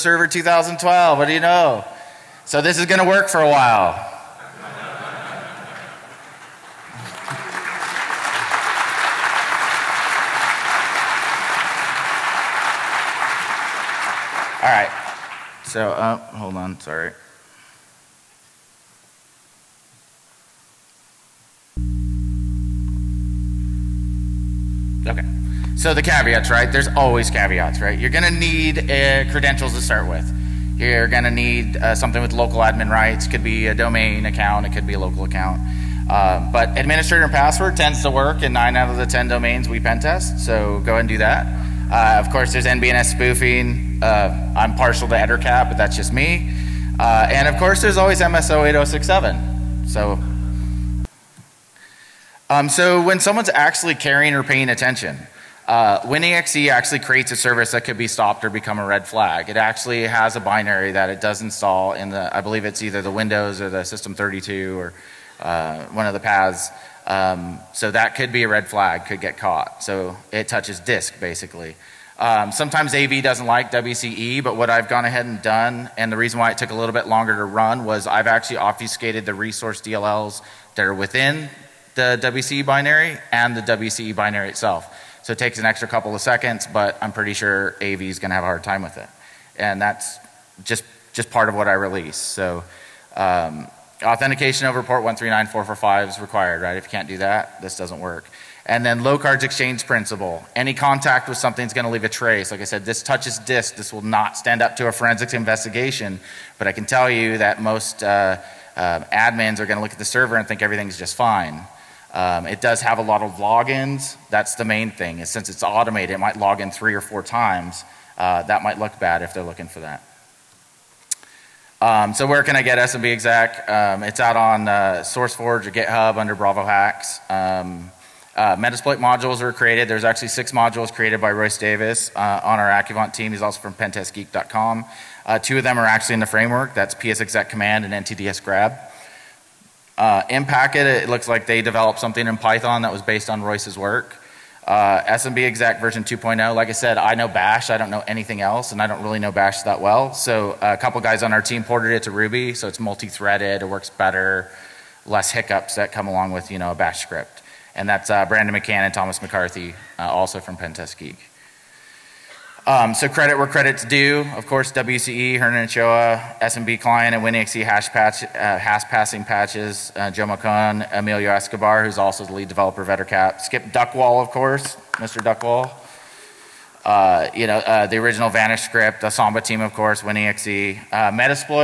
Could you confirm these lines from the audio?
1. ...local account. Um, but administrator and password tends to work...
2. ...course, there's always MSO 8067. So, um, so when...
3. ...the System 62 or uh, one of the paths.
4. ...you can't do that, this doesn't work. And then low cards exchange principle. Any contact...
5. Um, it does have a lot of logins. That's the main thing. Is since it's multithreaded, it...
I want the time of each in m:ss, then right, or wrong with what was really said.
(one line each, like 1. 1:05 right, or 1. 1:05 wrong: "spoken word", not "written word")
1. 0:34 right
2. 0:47 right
3. 1:03 wrong: "32", not "62"
4. 1:36 right
5. 1:52 wrong: "automated", not "multithreaded".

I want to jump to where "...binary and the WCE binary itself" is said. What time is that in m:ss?
1:22.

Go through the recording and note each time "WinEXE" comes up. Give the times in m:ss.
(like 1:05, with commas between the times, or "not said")
0:56, 3:00.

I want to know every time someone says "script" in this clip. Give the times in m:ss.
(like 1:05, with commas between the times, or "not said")
2:37, 2:58.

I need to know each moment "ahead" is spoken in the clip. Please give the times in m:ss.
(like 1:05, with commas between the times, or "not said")
0:40, 1:15.